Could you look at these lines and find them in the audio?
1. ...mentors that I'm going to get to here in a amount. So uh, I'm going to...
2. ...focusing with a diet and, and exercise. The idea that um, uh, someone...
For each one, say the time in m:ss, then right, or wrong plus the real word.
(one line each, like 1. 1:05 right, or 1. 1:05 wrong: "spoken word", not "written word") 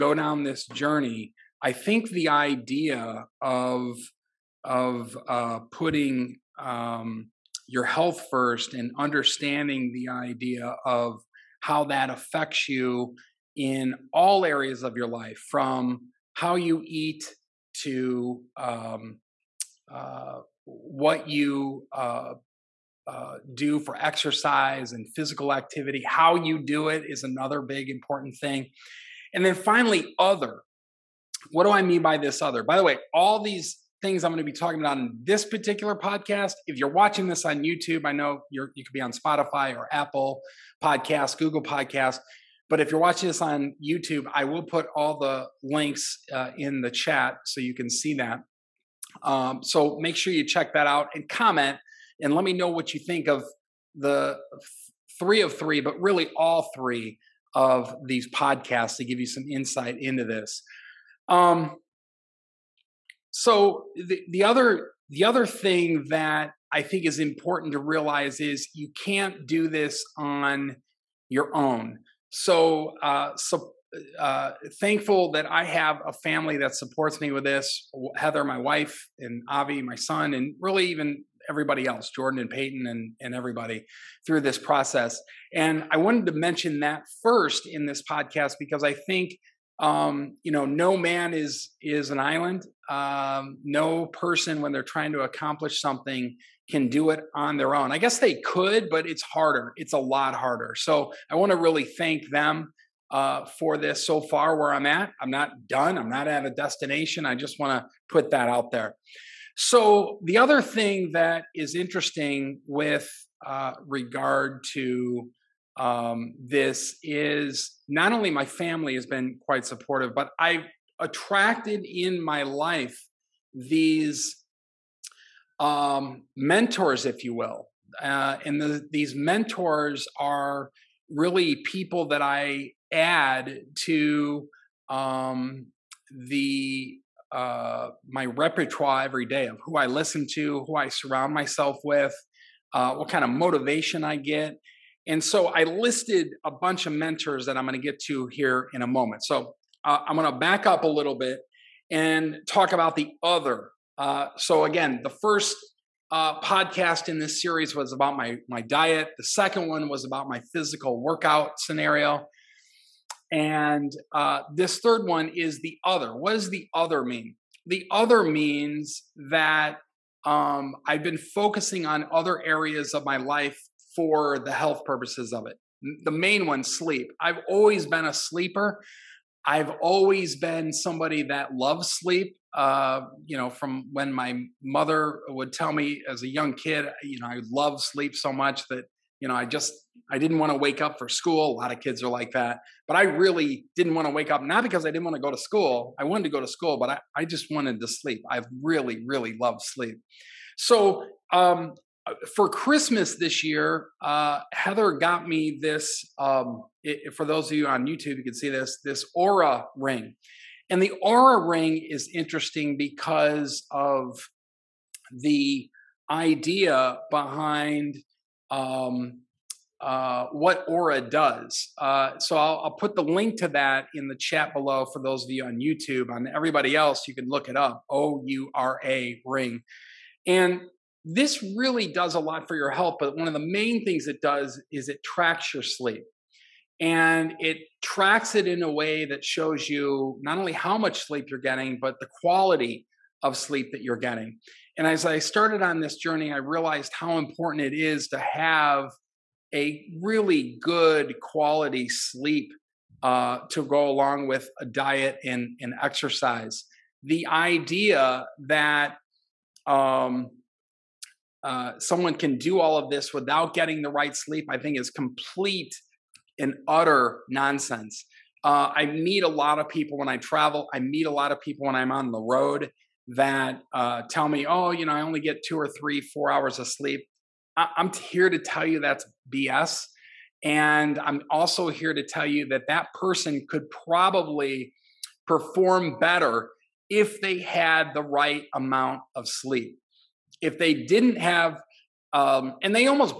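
1. 2:26 wrong: "moment", not "amount"
2. 4:13 wrong: "along", not "focusing".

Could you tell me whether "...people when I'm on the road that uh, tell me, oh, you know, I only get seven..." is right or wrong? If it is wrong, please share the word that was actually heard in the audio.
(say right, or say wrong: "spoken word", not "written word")
wrong: "two", not "seven".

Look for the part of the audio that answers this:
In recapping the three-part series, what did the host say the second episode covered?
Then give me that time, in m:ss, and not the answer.
2:40.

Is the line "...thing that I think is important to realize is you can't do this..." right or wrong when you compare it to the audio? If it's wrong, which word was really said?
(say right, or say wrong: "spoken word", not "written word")
right.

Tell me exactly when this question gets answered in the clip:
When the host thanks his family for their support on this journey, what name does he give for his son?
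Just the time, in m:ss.
1:19.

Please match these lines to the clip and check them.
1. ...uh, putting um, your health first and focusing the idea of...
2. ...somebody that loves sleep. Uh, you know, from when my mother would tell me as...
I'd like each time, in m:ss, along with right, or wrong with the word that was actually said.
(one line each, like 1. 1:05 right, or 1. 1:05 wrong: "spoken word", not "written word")
1. 0:05 wrong: "understanding", not "focusing"
2. 3:00 right.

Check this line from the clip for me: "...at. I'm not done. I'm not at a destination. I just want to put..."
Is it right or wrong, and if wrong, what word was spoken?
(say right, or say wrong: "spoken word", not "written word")
right.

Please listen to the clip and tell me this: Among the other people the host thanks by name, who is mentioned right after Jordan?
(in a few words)
Peyton.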